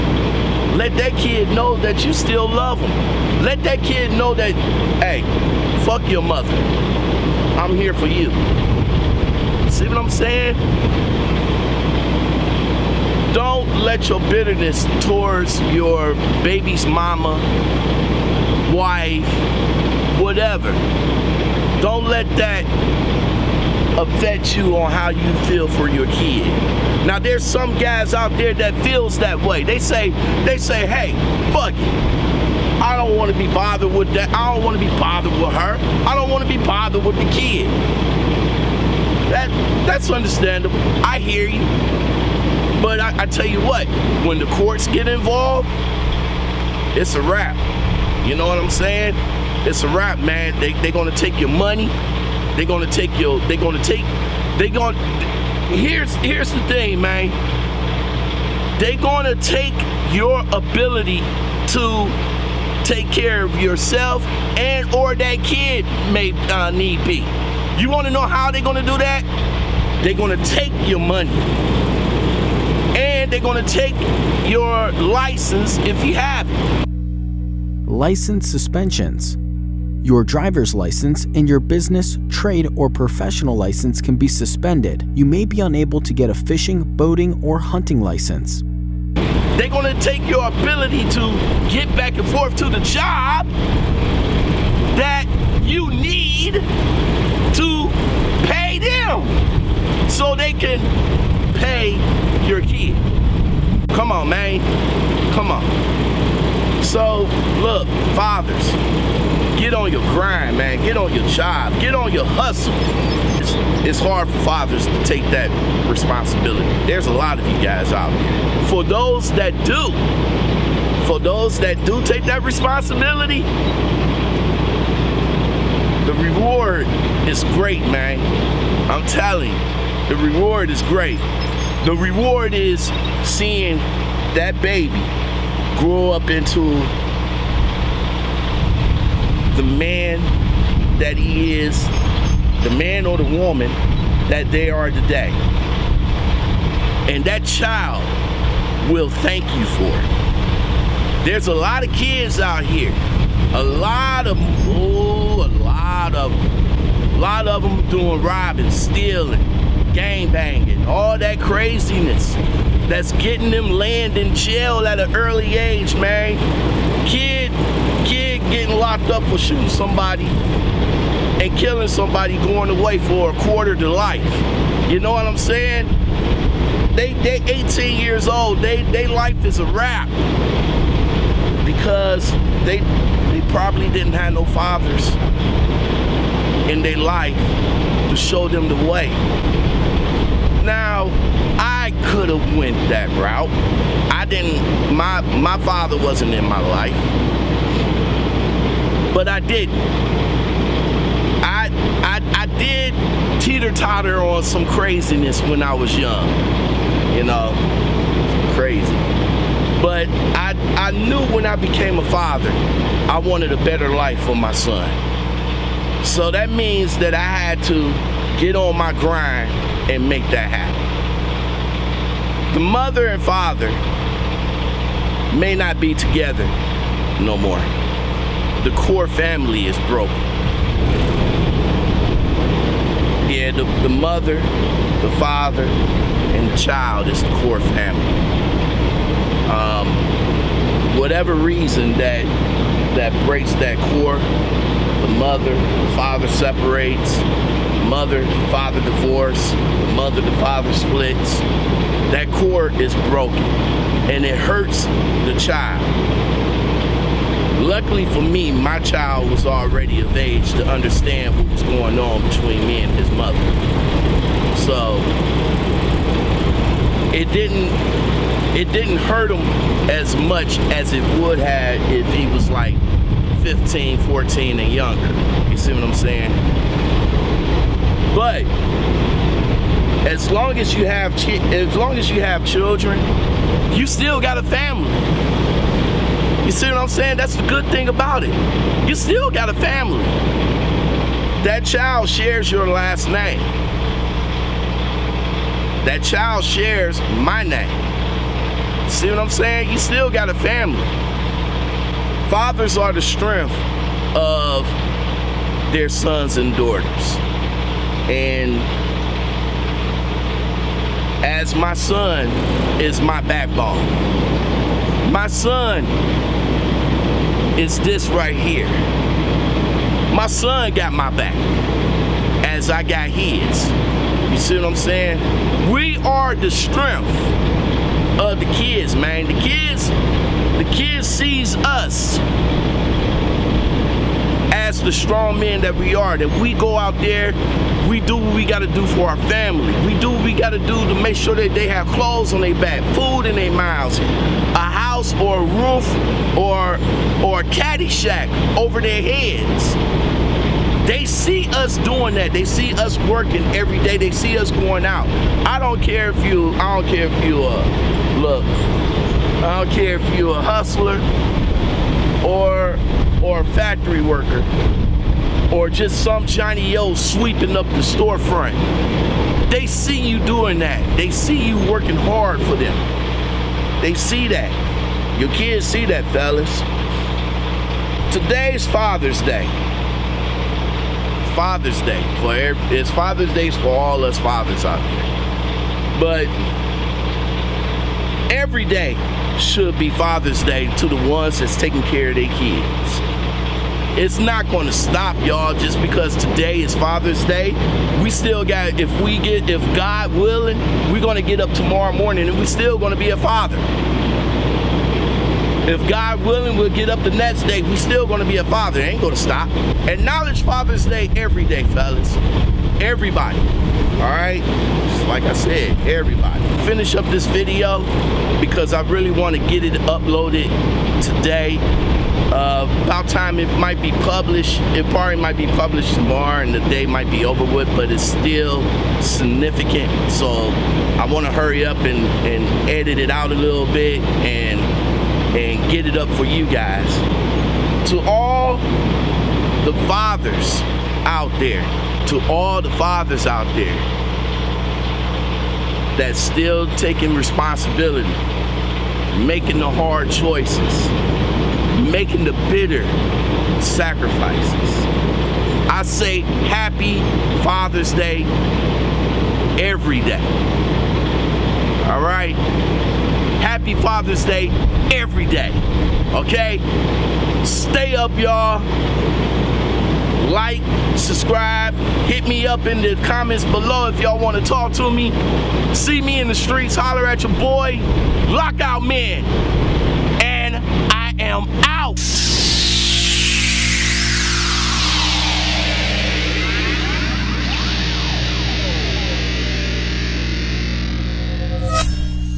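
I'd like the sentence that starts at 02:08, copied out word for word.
I'm telling you the reward is great.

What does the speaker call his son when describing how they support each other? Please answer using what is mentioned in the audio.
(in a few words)
Backbone.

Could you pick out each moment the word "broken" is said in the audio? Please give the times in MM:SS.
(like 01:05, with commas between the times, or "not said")
03:49, 04:13.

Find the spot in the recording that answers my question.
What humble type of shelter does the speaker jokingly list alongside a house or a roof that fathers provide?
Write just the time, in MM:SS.
05:47.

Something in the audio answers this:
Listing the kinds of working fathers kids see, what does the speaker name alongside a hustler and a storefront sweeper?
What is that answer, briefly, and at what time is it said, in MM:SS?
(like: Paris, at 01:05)
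Factory worker, at 06:03.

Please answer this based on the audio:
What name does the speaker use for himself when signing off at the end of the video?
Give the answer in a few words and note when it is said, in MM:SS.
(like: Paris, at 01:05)
Lockout Man, at 07:58.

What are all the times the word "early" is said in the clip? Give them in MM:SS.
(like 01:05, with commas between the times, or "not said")
02:45.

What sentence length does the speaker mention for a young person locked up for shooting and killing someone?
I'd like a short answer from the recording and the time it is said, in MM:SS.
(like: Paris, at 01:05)
A quarter to life, at 02:53.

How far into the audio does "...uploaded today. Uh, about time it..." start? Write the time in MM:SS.
06:59.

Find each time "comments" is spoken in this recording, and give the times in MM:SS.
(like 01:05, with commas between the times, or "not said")
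07:53.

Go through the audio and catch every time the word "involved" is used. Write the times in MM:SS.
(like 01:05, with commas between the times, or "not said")
00:45.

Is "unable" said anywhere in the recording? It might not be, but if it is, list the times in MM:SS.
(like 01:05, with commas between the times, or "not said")
01:25.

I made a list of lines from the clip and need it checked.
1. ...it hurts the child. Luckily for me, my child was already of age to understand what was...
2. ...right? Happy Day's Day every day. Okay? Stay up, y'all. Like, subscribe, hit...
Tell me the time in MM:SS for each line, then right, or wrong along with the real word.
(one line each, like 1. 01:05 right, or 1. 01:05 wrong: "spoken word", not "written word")
1. 04:14 right
2. 07:41 wrong: "Father", not "Day".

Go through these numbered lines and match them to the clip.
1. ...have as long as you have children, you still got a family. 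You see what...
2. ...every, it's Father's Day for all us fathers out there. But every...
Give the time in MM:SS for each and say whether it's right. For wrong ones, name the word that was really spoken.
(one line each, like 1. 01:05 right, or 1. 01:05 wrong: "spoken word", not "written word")
1. 04:40 right
2. 06:22 right.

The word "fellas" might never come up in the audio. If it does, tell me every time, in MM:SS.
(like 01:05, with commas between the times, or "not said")
06:16, 06:51.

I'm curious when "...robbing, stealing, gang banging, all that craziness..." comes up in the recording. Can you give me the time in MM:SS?
02:38.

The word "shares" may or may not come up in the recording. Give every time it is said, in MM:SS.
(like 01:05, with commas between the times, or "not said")
04:52, 04:56.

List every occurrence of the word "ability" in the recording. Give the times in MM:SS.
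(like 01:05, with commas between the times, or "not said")
01:00, 01:30.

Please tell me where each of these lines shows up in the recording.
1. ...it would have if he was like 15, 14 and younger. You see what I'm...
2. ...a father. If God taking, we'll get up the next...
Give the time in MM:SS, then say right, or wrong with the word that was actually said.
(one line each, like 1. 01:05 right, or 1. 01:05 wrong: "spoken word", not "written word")
1. 04:30 right
2. 06:43 wrong: "willing", not "taking".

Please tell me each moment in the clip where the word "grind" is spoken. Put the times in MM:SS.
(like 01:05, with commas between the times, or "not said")
01:50, 03:38.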